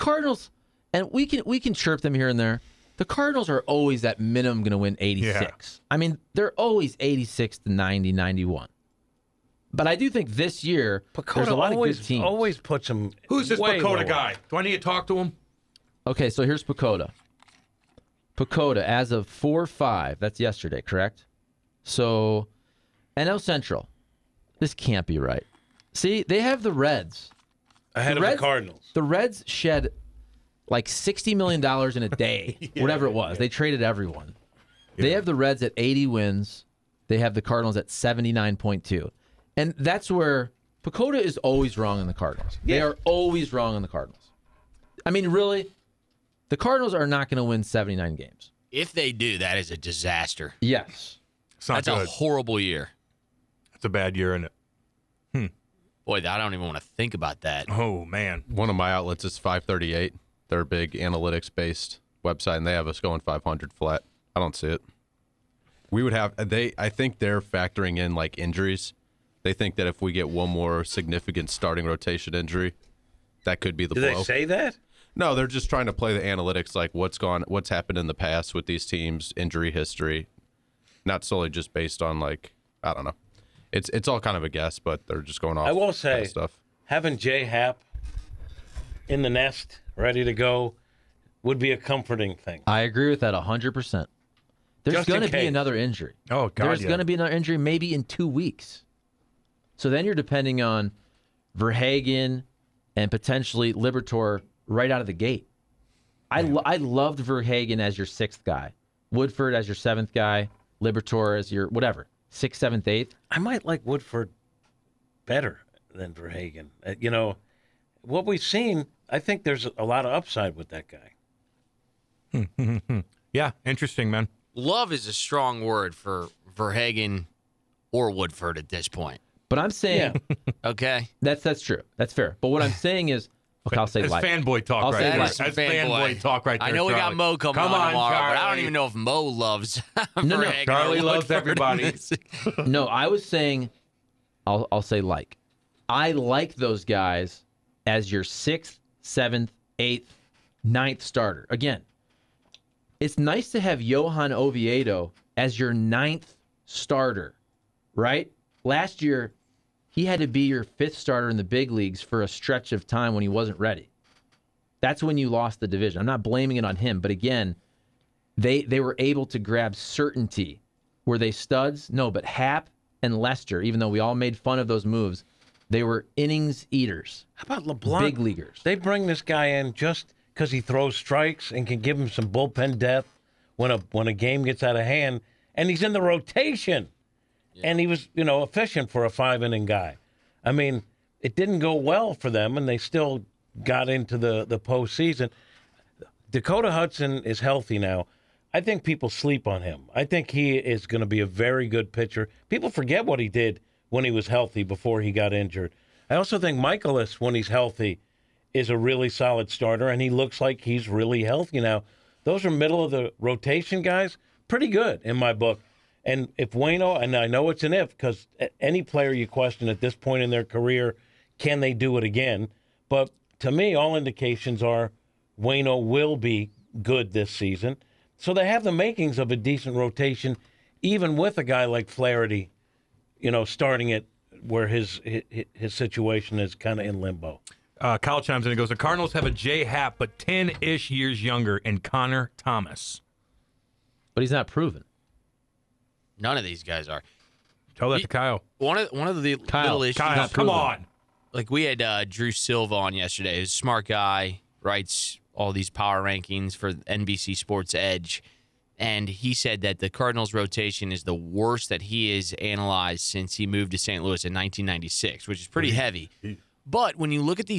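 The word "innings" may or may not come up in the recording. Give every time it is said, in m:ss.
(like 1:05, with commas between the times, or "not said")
2:56, 3:09.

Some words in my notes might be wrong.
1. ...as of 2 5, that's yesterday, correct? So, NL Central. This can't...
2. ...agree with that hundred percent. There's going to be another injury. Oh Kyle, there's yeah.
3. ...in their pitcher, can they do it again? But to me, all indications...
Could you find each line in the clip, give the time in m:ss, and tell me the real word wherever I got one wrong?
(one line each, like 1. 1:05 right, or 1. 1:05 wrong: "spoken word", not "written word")
1. 0:18 wrong: "4", not "2"
2. 1:32 wrong: "God", not "Kyle"
3. 3:40 wrong: "career", not "pitcher".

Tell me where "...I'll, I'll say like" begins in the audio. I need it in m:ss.
2:24.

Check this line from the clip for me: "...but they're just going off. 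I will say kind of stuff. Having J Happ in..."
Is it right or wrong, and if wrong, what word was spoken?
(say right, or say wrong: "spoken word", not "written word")
right.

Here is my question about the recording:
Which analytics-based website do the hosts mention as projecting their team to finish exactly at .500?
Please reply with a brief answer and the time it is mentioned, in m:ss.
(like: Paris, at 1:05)
538, at 0:59.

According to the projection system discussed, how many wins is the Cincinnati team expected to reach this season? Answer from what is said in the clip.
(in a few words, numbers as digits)
80.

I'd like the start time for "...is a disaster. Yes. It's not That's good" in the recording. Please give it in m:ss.
0:49.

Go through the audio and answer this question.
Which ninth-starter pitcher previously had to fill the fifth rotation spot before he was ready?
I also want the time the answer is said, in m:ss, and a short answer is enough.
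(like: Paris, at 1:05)
Johan Oviedo, at 2:33.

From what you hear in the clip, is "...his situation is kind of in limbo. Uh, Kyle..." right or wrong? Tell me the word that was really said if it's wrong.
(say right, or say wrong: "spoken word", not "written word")
right.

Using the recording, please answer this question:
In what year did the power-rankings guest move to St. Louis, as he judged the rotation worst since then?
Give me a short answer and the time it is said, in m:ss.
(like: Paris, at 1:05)
1996, at 4:24.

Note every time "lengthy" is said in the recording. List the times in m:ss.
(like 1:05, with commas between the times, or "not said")
not said.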